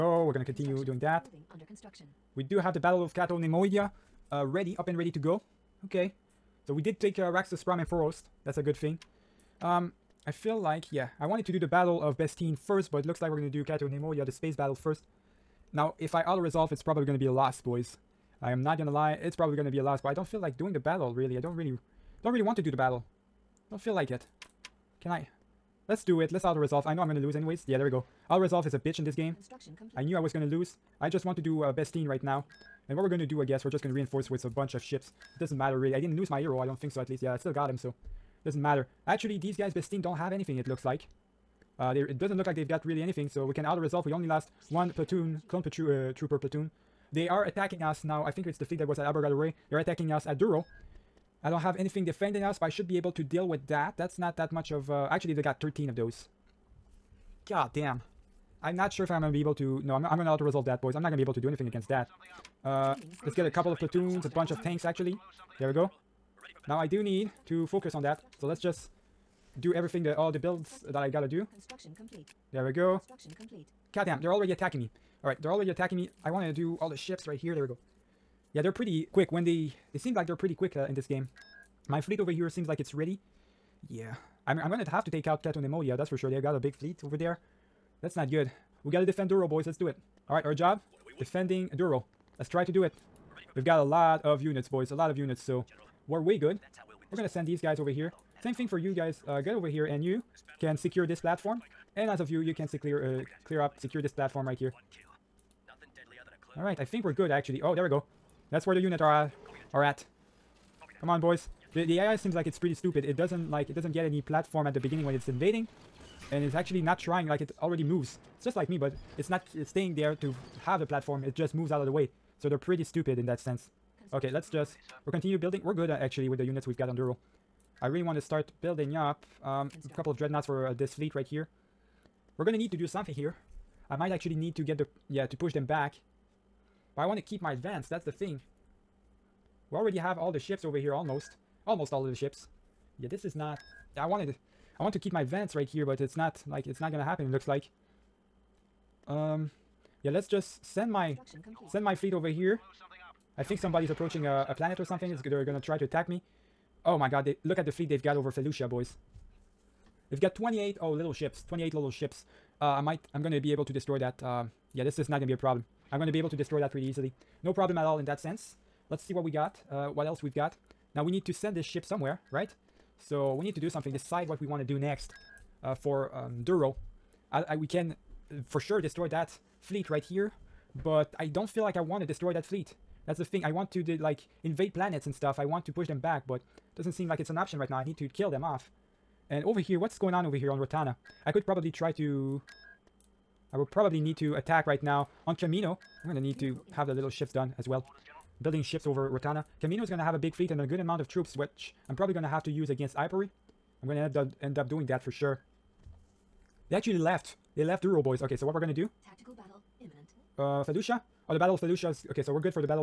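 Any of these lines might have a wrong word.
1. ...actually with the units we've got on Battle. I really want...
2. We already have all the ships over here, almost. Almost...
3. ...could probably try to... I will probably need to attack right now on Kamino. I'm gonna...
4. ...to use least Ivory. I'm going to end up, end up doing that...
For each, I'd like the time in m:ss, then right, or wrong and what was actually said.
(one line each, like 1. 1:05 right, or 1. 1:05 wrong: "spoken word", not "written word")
1. 2:05 wrong: "Duro", not "Battle"
2. 2:19 right
3. 3:11 right
4. 3:22 wrong: "against", not "least".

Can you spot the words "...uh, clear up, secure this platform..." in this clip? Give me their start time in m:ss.
1:43.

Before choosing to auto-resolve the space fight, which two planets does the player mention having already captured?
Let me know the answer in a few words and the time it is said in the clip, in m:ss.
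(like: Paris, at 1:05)
Raxus Prime and Foerost, at 0:07.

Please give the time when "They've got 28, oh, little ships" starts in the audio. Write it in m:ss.
2:40.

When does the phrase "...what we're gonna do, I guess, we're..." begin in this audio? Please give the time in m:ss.
0:32.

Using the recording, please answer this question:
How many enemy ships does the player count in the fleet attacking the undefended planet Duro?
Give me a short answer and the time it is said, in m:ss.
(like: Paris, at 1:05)
13, at 0:55.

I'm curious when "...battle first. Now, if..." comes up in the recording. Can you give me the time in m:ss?
0:14.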